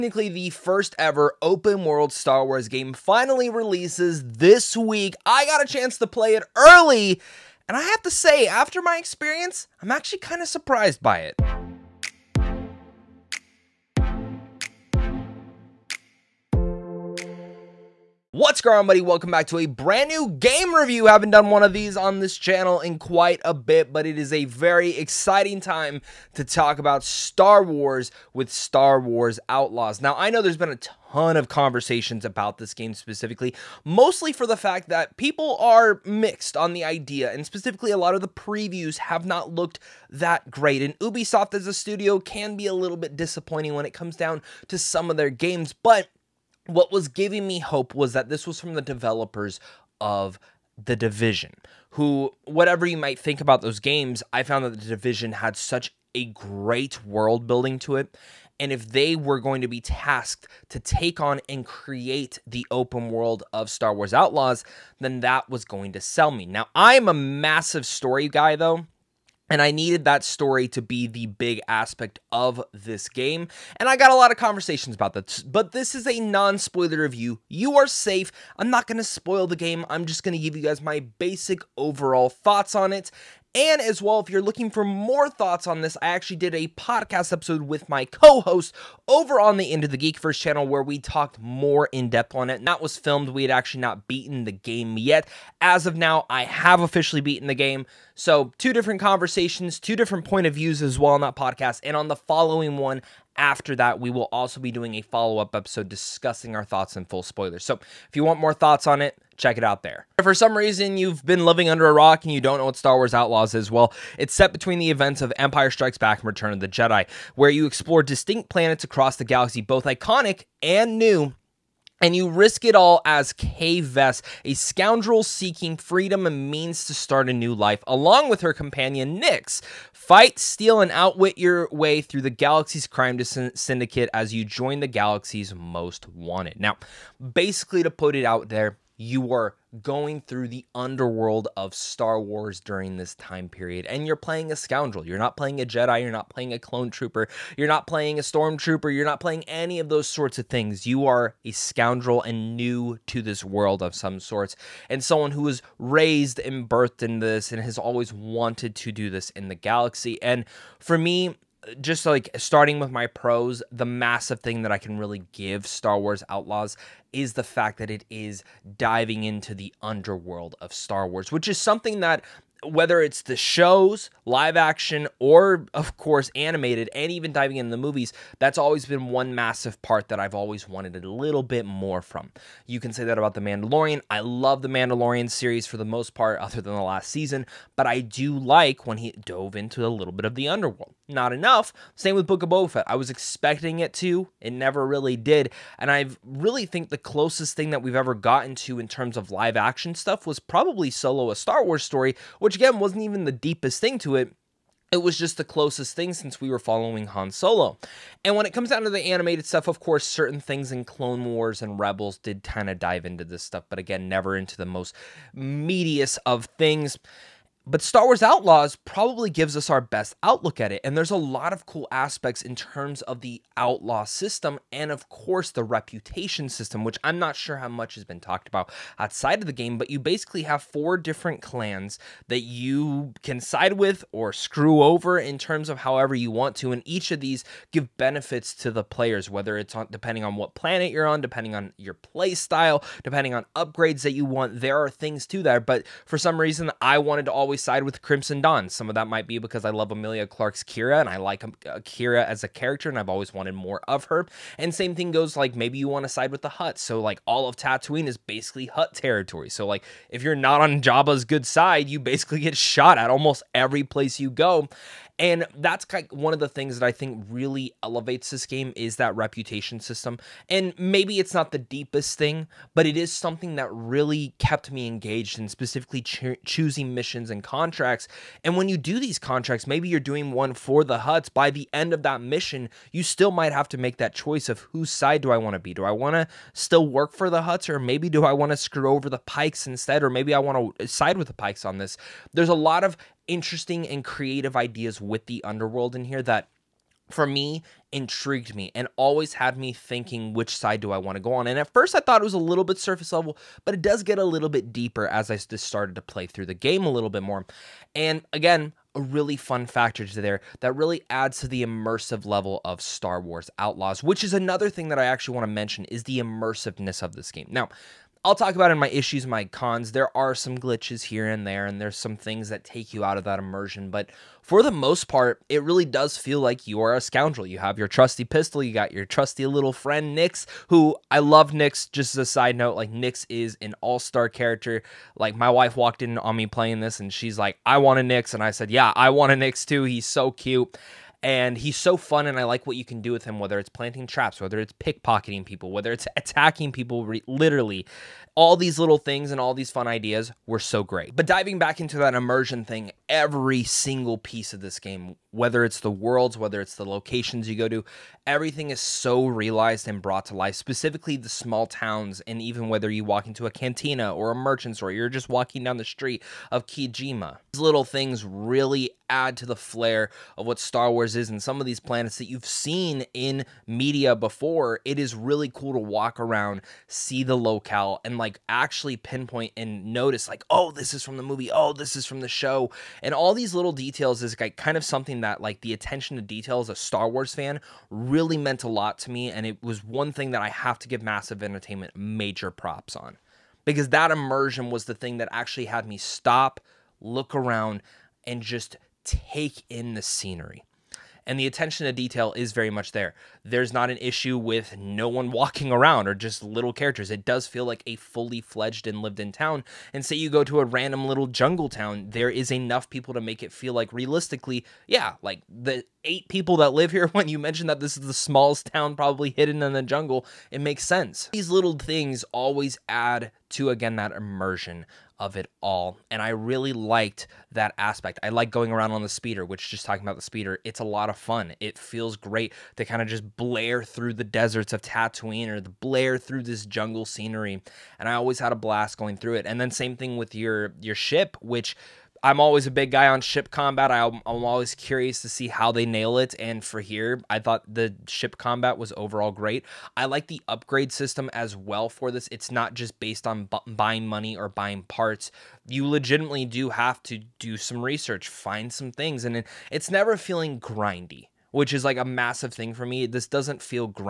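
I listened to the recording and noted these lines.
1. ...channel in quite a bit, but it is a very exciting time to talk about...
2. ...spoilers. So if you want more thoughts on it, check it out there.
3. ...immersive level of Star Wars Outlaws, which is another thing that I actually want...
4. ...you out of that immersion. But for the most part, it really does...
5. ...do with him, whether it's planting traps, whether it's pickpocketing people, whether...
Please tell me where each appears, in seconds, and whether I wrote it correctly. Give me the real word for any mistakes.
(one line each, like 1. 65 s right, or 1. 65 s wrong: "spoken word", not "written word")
1. 22 s right
2. 107 s right
3. 311 s right
4. 322 s right
5. 343 s right.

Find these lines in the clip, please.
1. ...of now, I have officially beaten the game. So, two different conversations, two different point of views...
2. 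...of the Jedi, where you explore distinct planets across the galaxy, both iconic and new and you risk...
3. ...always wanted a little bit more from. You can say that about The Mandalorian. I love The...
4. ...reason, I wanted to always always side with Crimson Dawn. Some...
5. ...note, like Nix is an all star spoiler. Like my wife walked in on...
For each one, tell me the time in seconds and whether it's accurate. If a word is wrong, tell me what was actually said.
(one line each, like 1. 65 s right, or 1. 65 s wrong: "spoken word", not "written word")
1. 95 s right
2. 116 s right
3. 180 s right
4. 246 s right
5. 332 s wrong: "character", not "spoiler".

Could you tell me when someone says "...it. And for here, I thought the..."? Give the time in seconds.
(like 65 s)
446 s.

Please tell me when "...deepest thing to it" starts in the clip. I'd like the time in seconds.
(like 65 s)
203 s.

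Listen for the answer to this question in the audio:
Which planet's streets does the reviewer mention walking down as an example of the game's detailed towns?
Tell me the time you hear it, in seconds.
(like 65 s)
366 s.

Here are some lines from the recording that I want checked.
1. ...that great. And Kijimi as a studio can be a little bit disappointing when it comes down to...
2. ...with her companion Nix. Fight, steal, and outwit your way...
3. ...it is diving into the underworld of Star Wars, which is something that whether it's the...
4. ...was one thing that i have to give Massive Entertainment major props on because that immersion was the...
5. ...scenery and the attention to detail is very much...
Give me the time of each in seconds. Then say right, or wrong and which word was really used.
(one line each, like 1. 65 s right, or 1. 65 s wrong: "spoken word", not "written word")
1. 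40 s wrong: "Ubisoft", not "Kijimi"
2. 128 s right
3. 167 s right
4. 389 s right
5. 400 s right.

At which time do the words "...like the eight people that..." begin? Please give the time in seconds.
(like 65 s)
415 s.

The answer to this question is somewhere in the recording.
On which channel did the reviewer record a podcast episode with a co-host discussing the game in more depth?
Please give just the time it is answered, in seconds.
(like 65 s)
89 s.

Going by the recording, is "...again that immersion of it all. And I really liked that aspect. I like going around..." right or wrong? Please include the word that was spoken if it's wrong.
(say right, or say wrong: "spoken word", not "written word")
right.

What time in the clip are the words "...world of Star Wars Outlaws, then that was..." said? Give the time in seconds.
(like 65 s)
63 s.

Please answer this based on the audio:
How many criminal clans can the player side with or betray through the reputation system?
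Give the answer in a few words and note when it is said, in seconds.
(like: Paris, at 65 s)
4, at 230 s.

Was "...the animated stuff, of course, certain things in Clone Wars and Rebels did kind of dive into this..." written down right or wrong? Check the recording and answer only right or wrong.
right.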